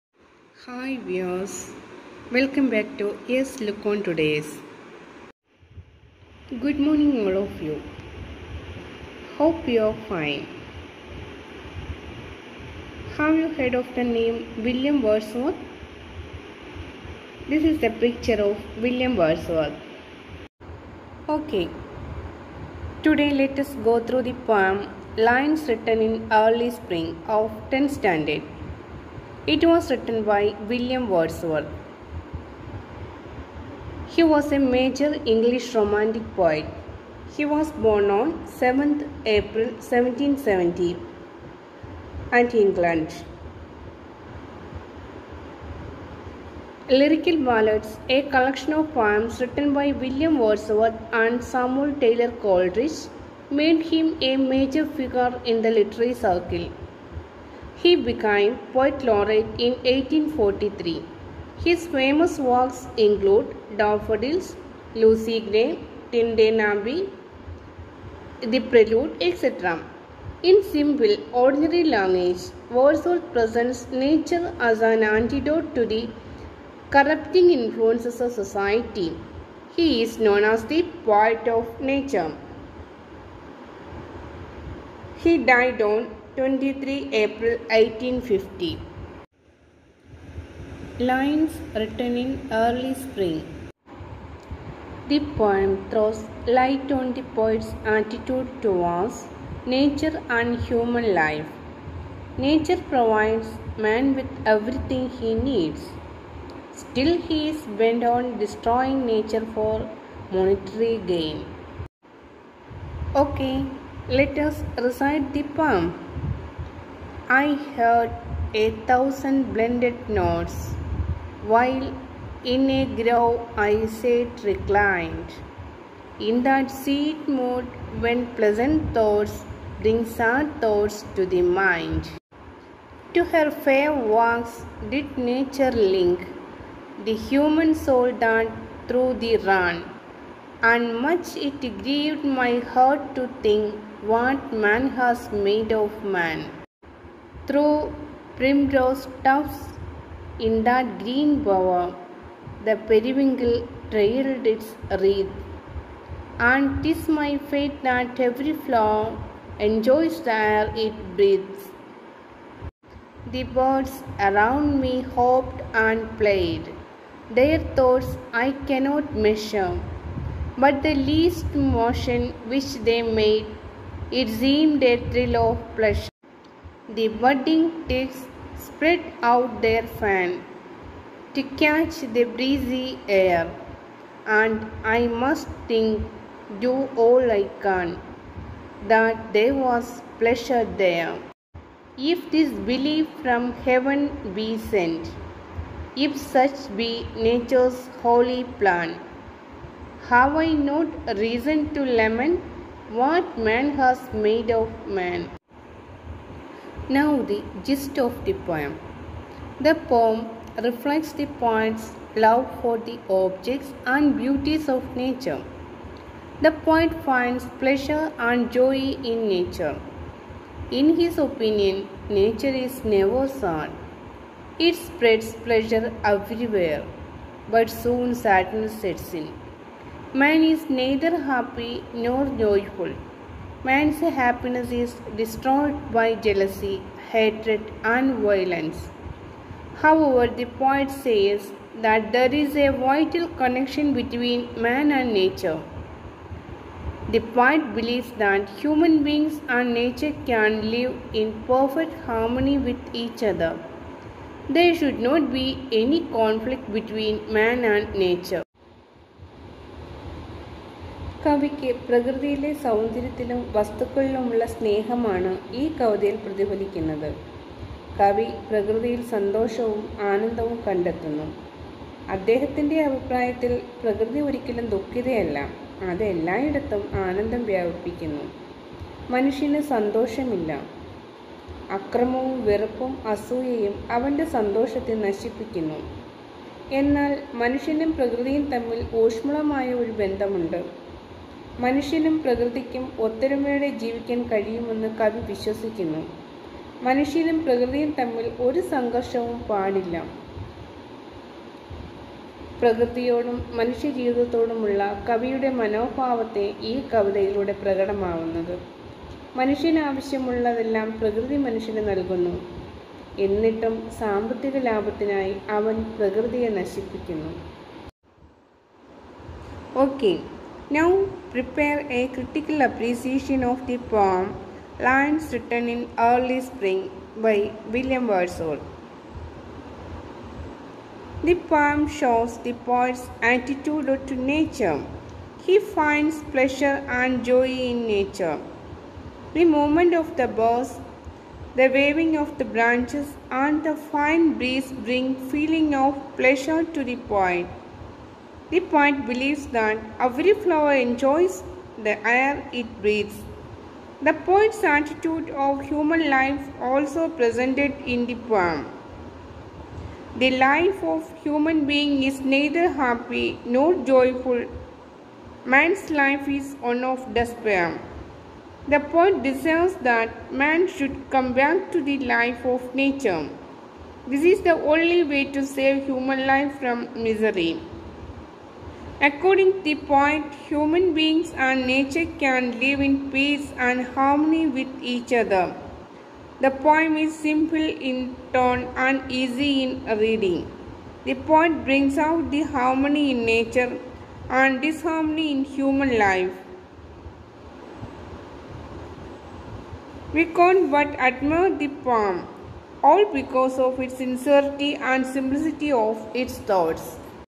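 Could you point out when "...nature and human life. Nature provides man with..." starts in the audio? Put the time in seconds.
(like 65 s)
99 s.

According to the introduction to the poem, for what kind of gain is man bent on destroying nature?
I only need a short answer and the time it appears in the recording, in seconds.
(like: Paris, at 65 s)
monetary gain, at 110 s.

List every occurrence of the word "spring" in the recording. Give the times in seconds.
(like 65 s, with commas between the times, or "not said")
26 s, 92 s, 326 s.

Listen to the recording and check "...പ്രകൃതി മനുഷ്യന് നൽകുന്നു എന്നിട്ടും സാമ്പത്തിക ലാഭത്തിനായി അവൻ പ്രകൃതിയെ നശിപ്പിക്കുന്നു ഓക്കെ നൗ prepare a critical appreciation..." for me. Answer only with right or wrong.
right.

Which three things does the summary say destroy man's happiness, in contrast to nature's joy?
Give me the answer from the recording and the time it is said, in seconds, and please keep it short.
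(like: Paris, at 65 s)
jealousy, hatred, and violence, at 236 s.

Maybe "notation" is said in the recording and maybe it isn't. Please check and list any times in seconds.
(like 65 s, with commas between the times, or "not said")
not said.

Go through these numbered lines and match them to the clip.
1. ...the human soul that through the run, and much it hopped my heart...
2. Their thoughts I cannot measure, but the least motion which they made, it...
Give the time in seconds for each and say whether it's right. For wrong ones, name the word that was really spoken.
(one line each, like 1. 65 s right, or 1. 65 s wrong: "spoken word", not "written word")
1. 137 s wrong: "grieved", not "hopped"
2. 167 s right.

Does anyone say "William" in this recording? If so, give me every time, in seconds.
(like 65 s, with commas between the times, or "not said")
14 s, 18 s, 30 s, 49 s, 327 s.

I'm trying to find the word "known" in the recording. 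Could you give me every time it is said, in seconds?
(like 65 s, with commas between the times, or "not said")
80 s.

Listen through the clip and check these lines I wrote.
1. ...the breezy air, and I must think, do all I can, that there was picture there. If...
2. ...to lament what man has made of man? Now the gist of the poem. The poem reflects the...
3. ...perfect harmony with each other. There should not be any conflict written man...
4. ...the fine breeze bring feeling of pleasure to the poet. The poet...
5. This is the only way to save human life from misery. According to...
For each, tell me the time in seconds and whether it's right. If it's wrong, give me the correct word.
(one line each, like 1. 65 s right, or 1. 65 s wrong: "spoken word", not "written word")
1. 182 s wrong: "pleasure", not "picture"
2. 201 s right
3. 251 s wrong: "between", not "written"
4. 343 s right
5. 374 s right.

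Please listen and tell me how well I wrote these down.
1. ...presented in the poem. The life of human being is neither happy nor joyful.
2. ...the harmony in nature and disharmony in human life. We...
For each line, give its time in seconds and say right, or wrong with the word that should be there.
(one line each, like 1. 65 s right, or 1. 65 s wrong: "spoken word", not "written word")
1. 357 s right
2. 392 s right.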